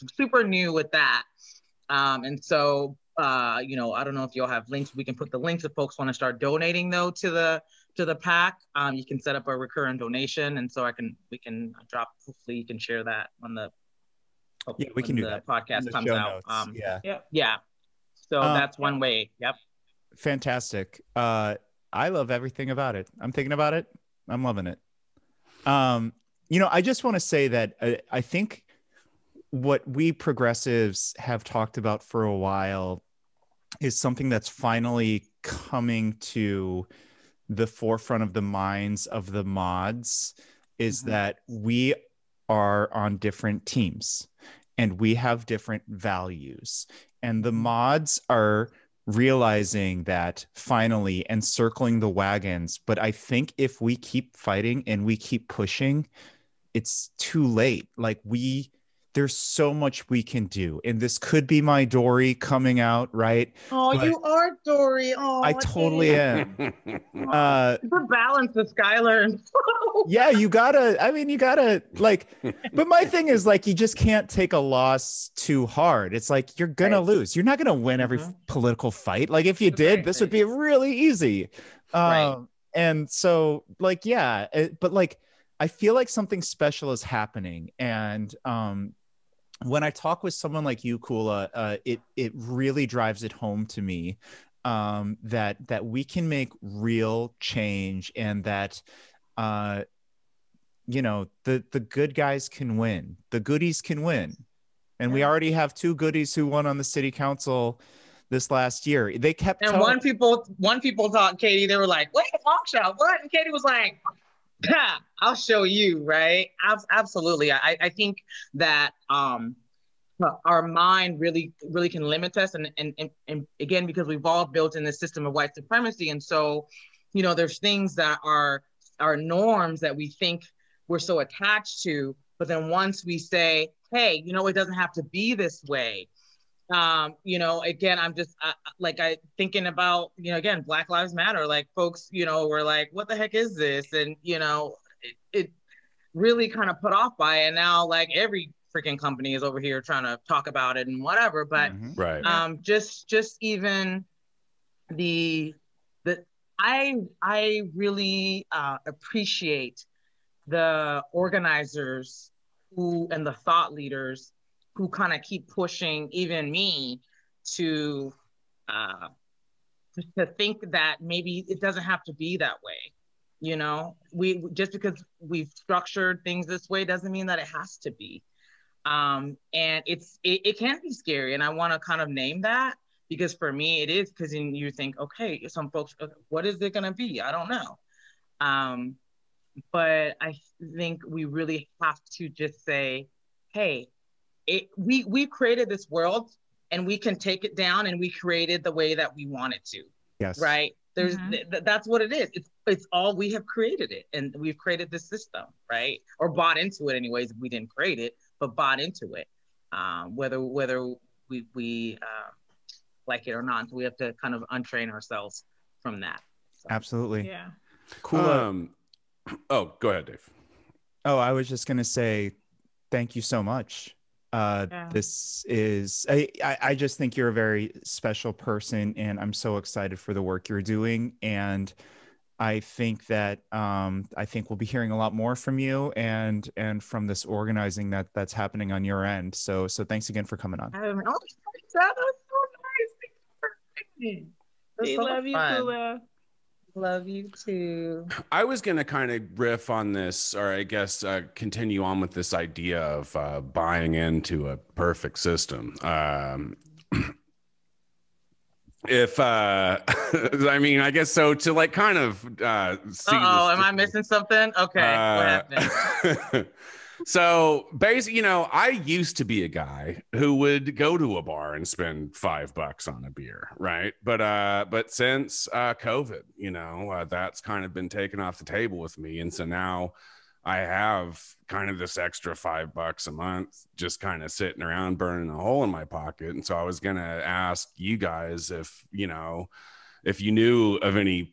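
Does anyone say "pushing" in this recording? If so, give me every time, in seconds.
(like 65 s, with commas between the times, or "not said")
55 s, 165 s.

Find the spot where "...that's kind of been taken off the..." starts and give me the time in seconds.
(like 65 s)
277 s.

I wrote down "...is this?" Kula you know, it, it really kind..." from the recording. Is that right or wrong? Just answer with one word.
wrong.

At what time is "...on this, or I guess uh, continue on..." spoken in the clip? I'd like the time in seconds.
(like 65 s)
249 s.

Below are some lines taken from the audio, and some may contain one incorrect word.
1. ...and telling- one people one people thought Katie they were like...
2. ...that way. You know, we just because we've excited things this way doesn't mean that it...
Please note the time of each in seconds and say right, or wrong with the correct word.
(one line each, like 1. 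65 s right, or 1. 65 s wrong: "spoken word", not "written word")
1. 109 s right
2. 172 s wrong: "structured", not "excited".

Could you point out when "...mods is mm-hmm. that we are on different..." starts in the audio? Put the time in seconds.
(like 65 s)
39 s.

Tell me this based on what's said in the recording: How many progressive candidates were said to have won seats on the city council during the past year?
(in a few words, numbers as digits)
2.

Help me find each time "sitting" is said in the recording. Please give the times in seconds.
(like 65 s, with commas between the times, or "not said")
284 s.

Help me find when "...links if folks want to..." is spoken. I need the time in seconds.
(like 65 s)
5 s.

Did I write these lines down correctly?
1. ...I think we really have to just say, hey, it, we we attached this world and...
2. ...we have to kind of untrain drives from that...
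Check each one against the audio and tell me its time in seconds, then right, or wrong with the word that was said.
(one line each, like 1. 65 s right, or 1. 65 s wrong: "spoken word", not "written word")
1. 190 s wrong: "created", not "attached"
2. 213 s wrong: "ourselves", not "drives".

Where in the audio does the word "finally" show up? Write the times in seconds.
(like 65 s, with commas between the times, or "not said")
34 s, 50 s.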